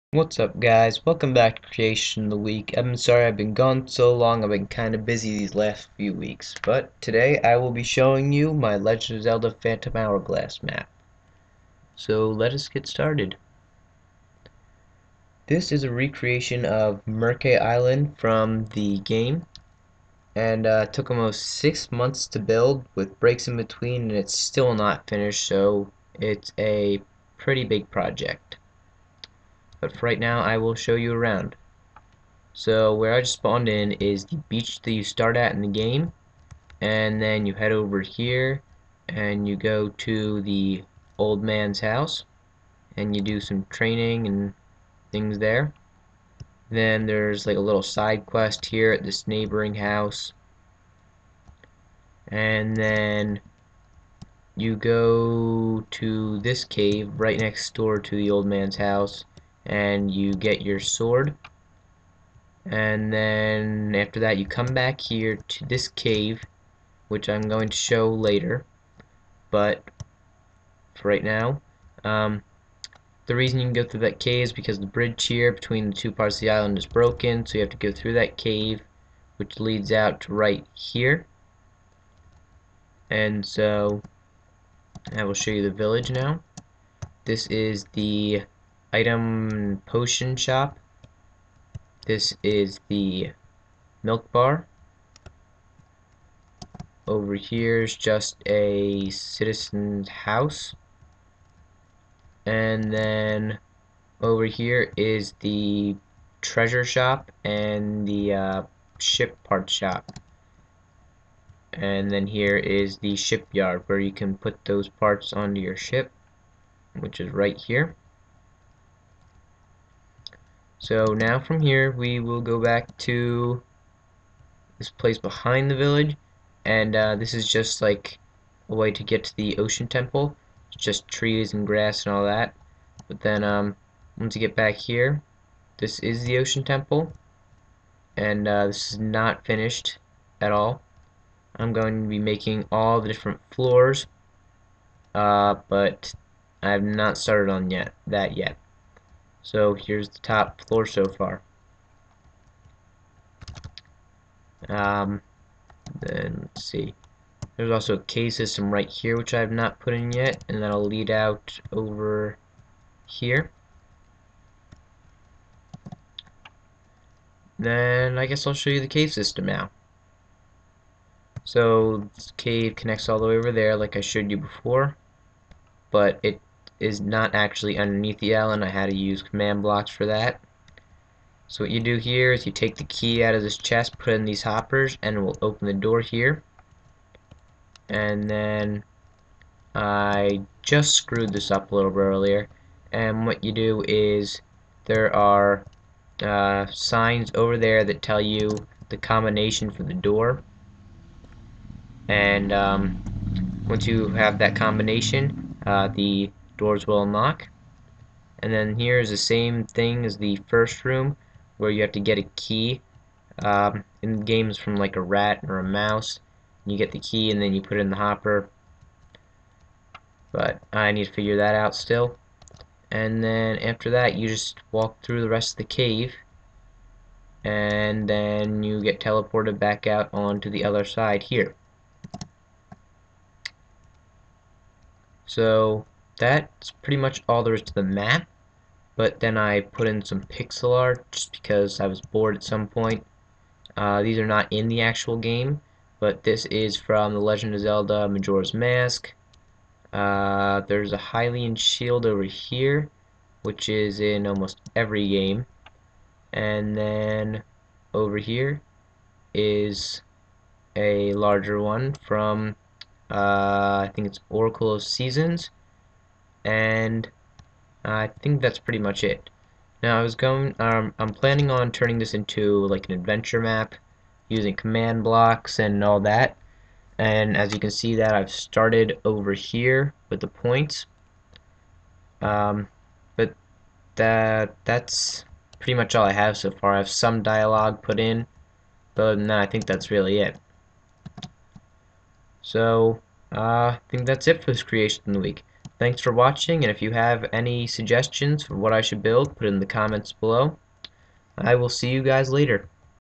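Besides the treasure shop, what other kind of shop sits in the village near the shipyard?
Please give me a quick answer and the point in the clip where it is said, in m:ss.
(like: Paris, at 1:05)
Ship part shop, at 1:48.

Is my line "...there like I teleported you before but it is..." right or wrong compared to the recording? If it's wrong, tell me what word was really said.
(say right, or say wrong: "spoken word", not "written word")
wrong: "showed", not "teleported".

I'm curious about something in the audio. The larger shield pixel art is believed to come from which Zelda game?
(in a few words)
Oracle of Seasons.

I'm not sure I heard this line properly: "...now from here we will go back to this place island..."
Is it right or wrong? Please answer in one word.
wrong.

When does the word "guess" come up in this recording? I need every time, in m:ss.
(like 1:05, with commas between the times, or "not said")
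2:48.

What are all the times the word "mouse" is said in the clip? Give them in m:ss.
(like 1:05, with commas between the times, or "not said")
3:35.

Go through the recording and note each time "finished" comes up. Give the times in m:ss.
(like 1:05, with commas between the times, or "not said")
0:25, 2:19.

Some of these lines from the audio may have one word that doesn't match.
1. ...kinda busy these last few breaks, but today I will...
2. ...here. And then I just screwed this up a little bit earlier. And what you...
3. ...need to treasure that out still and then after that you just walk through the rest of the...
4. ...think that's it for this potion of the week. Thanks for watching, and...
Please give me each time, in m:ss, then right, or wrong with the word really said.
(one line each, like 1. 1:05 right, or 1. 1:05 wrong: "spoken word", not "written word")
1. 0:04 wrong: "weeks", not "breaks"
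2. 3:06 right
3. 3:40 wrong: "figure", not "treasure"
4. 4:53 wrong: "creation", not "potion".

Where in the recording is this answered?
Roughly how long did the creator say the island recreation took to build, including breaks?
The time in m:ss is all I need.
0:21.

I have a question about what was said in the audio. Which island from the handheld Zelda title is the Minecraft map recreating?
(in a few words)
Mercay Island.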